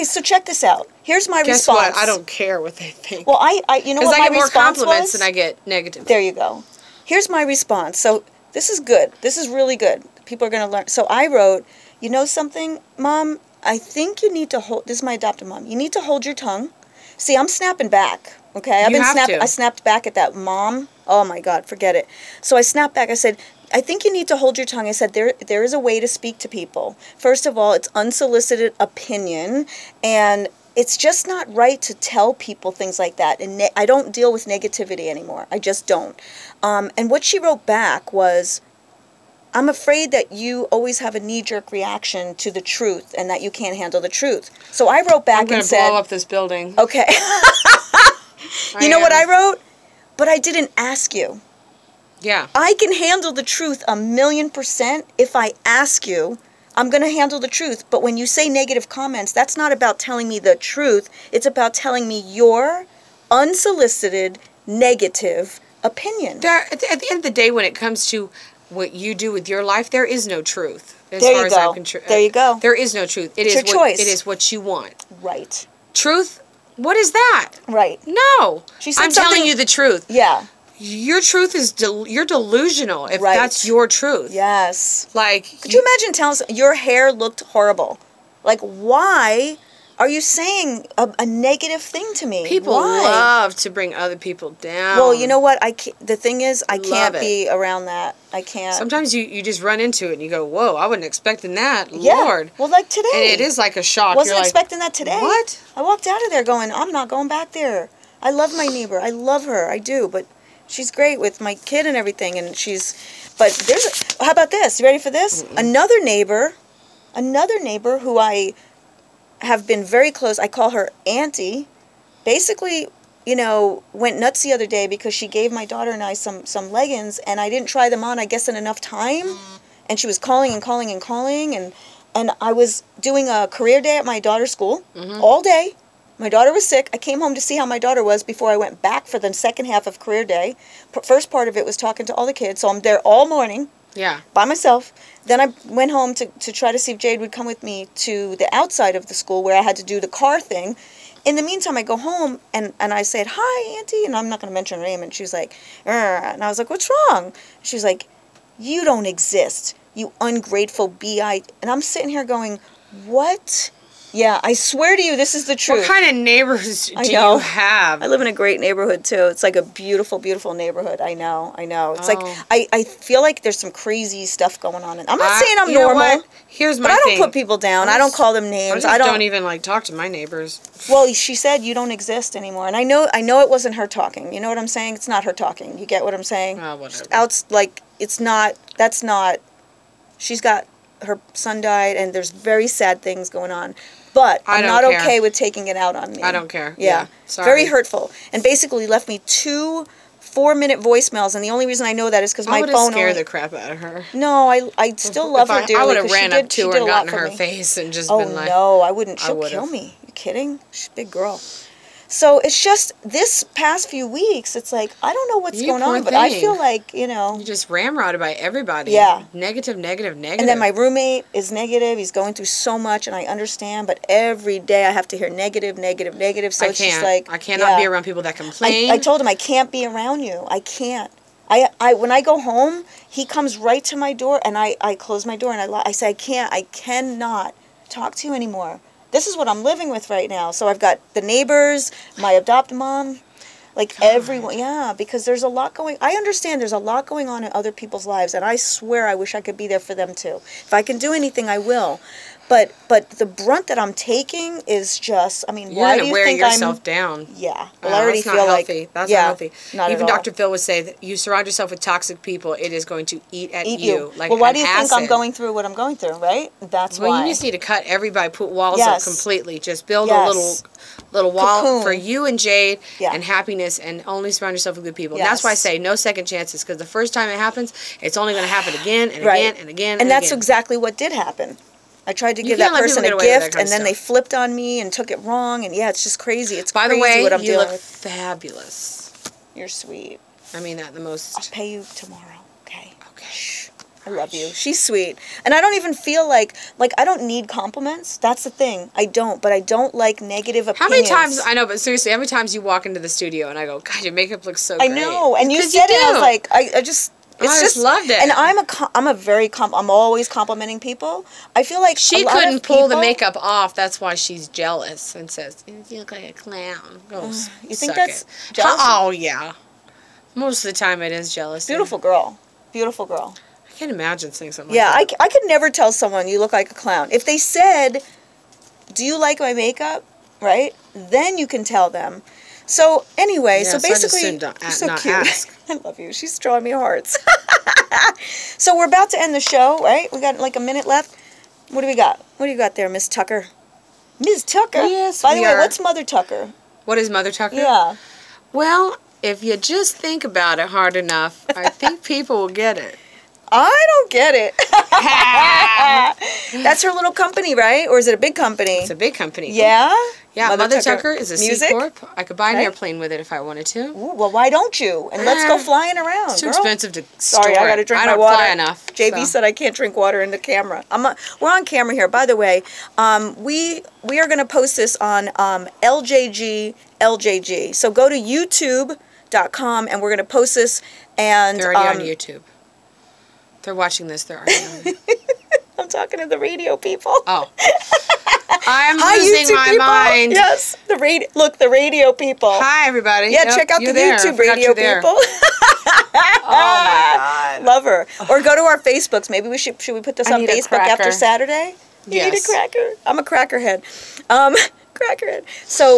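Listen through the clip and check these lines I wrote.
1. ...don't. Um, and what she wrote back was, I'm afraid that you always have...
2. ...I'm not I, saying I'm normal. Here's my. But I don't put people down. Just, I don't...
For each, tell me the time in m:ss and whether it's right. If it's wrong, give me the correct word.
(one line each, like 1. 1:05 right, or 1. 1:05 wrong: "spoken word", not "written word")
1. 0:35 right
2. 2:55 right.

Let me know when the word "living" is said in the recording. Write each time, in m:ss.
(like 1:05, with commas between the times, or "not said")
3:59.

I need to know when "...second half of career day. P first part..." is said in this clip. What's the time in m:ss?
2:19.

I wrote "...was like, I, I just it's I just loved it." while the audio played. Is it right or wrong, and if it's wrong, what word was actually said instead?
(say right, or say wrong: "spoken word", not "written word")
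right.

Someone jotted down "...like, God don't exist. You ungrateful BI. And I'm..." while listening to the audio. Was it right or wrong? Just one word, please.
wrong.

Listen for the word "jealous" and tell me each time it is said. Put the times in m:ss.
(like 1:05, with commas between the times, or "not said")
5:14, 5:21.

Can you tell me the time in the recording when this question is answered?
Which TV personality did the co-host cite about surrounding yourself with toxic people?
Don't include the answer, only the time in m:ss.
4:20.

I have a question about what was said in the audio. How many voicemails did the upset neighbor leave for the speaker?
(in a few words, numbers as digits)
2.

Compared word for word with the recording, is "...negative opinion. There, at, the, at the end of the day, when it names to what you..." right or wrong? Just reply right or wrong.
wrong.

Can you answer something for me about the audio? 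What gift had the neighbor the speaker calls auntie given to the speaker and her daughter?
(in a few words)
leggings.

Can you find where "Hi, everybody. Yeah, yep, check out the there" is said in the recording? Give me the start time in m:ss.
6:32.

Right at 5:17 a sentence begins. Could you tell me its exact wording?
Oh, you think that's Oh yeah.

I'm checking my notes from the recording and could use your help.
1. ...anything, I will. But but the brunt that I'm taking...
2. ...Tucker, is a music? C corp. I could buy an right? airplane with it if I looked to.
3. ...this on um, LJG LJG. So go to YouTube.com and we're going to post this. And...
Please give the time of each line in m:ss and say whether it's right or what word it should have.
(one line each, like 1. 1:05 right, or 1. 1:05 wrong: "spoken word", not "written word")
1. 4:11 right
2. 6:00 wrong: "wanted", not "looked"
3. 6:14 right.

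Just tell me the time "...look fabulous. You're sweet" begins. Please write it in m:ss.
4:47.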